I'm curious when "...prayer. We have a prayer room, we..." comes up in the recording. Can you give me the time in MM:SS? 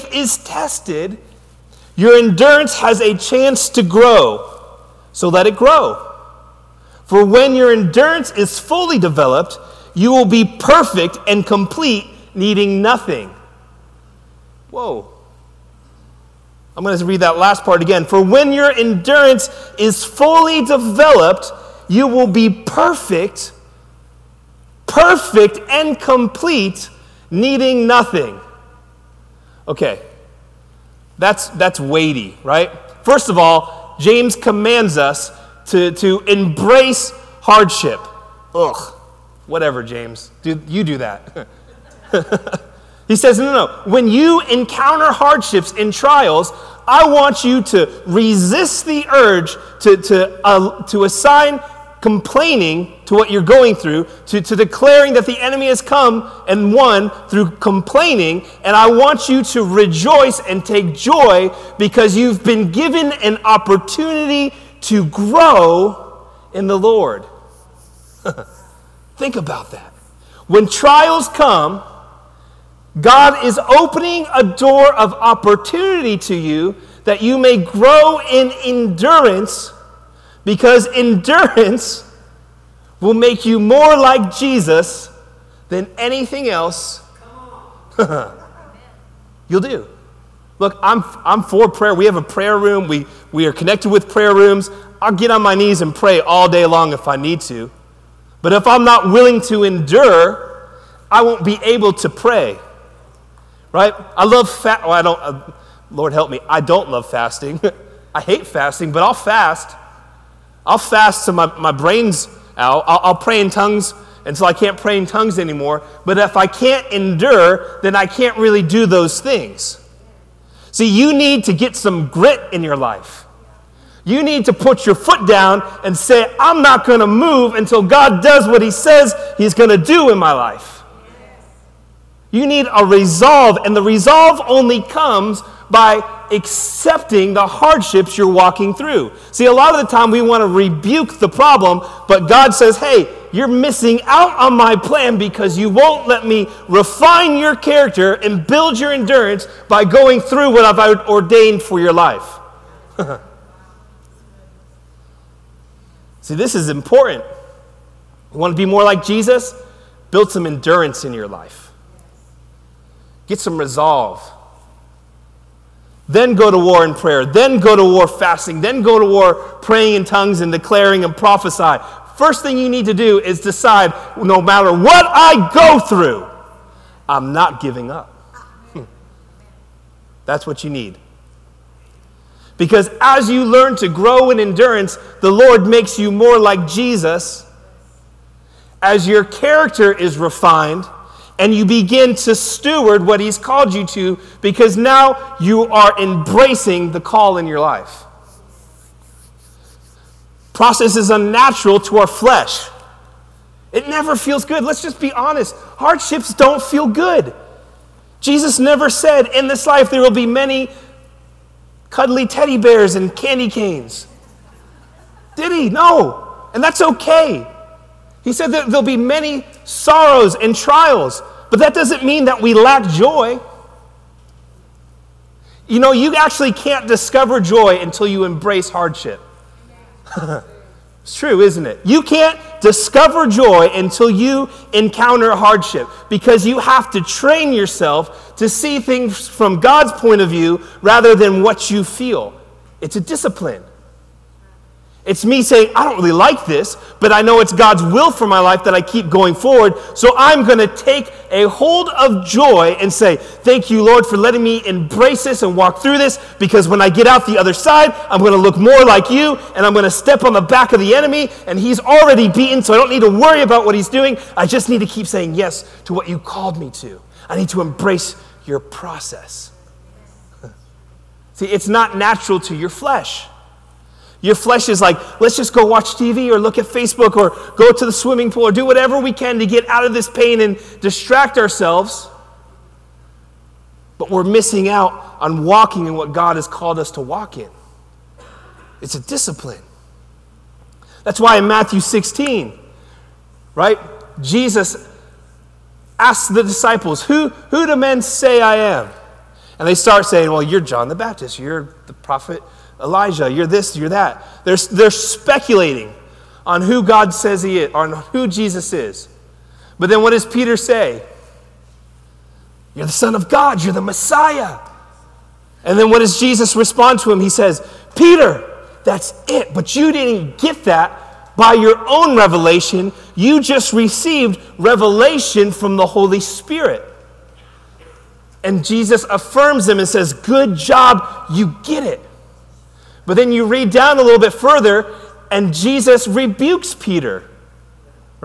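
01:31.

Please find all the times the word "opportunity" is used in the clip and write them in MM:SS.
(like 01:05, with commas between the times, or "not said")
01:03, 01:15.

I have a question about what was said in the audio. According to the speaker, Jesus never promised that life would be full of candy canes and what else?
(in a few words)
cuddly teddy bears.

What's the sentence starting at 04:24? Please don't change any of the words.
I just need to keep saying yes to what you called me to.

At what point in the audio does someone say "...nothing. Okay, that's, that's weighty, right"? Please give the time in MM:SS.
00:27.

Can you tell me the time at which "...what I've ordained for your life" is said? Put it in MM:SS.
02:30.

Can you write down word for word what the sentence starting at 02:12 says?
You need a resolve, and the resolve only comes by accepting the hardships you're walking through.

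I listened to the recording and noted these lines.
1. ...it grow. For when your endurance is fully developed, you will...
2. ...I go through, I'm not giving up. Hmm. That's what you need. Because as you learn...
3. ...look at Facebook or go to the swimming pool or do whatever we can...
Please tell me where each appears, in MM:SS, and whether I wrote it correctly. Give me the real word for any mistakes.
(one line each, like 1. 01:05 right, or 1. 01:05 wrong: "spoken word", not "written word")
1. 00:05 right
2. 02:55 right
3. 04:36 right.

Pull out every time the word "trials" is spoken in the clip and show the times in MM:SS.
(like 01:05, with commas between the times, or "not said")
00:45, 01:10, 03:40.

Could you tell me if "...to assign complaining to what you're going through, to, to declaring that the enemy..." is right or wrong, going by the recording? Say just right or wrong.
right.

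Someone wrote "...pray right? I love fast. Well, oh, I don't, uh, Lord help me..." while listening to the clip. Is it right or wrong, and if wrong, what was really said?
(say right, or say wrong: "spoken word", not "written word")
right.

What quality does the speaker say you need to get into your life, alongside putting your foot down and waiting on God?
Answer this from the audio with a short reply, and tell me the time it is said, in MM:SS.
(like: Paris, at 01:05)
grit, at 02:02.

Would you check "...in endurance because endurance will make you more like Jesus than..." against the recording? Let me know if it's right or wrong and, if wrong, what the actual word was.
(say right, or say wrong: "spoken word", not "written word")
right.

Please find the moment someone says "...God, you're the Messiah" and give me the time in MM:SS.
05:13.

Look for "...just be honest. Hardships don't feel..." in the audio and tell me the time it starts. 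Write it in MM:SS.
03:24.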